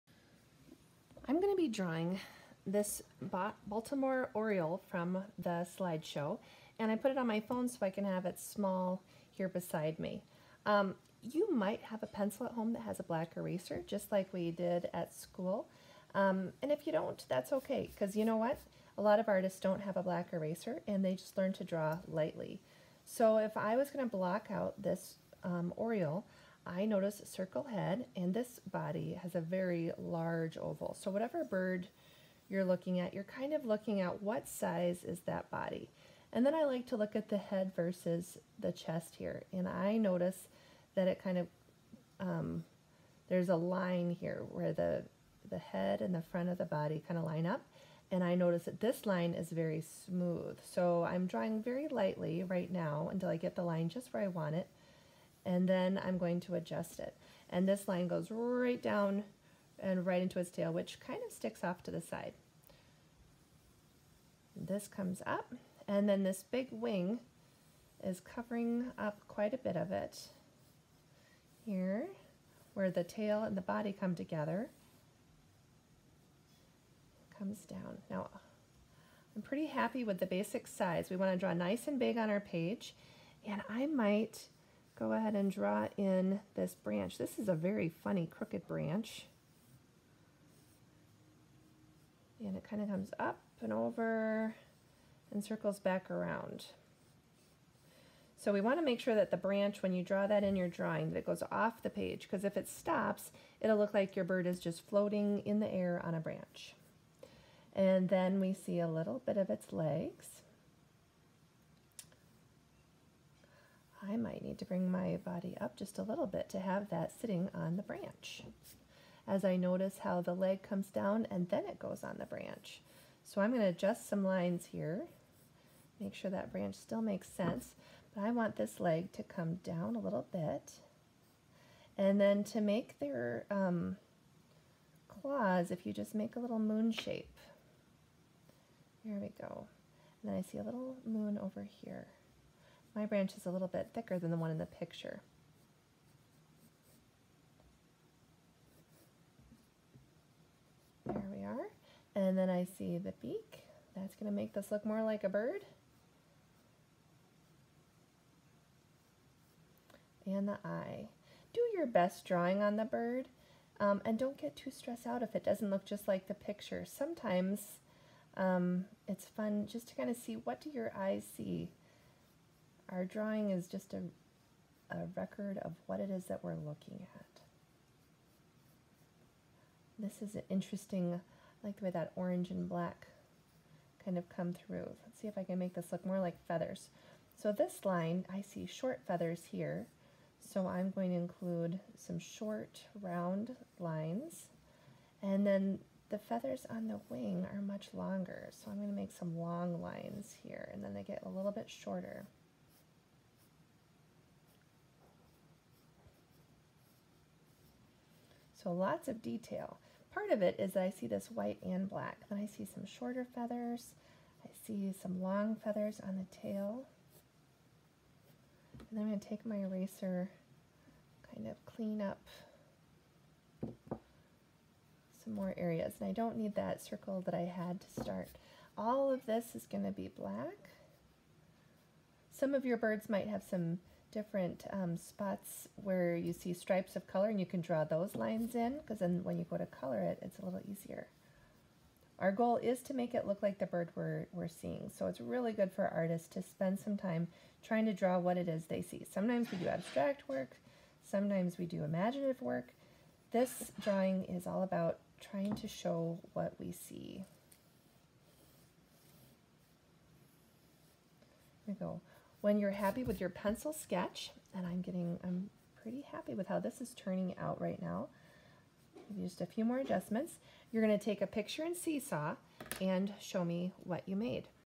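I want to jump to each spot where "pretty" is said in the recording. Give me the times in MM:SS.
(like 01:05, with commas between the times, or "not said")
01:19, 04:25.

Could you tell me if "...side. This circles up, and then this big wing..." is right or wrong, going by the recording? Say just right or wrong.
wrong.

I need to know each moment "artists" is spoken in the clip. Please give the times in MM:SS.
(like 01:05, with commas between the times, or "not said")
00:19, 04:05.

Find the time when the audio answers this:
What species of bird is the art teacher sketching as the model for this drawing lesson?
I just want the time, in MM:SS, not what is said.
00:03.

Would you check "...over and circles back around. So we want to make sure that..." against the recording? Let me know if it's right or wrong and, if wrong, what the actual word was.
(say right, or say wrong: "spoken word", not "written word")
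right.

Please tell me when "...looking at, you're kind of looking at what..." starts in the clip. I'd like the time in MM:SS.
00:32.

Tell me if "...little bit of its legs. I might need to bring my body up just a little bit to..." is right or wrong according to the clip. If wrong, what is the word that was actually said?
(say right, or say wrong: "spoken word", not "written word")
right.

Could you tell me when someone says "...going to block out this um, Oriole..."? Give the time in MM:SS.
00:23.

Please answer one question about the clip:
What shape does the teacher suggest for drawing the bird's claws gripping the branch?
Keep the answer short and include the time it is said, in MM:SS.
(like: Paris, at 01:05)
A little moon shape, at 02:16.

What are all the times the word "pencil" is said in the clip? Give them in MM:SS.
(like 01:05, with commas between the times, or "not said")
00:12, 04:23.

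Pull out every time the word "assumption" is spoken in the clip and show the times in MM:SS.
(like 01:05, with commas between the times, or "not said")
not said.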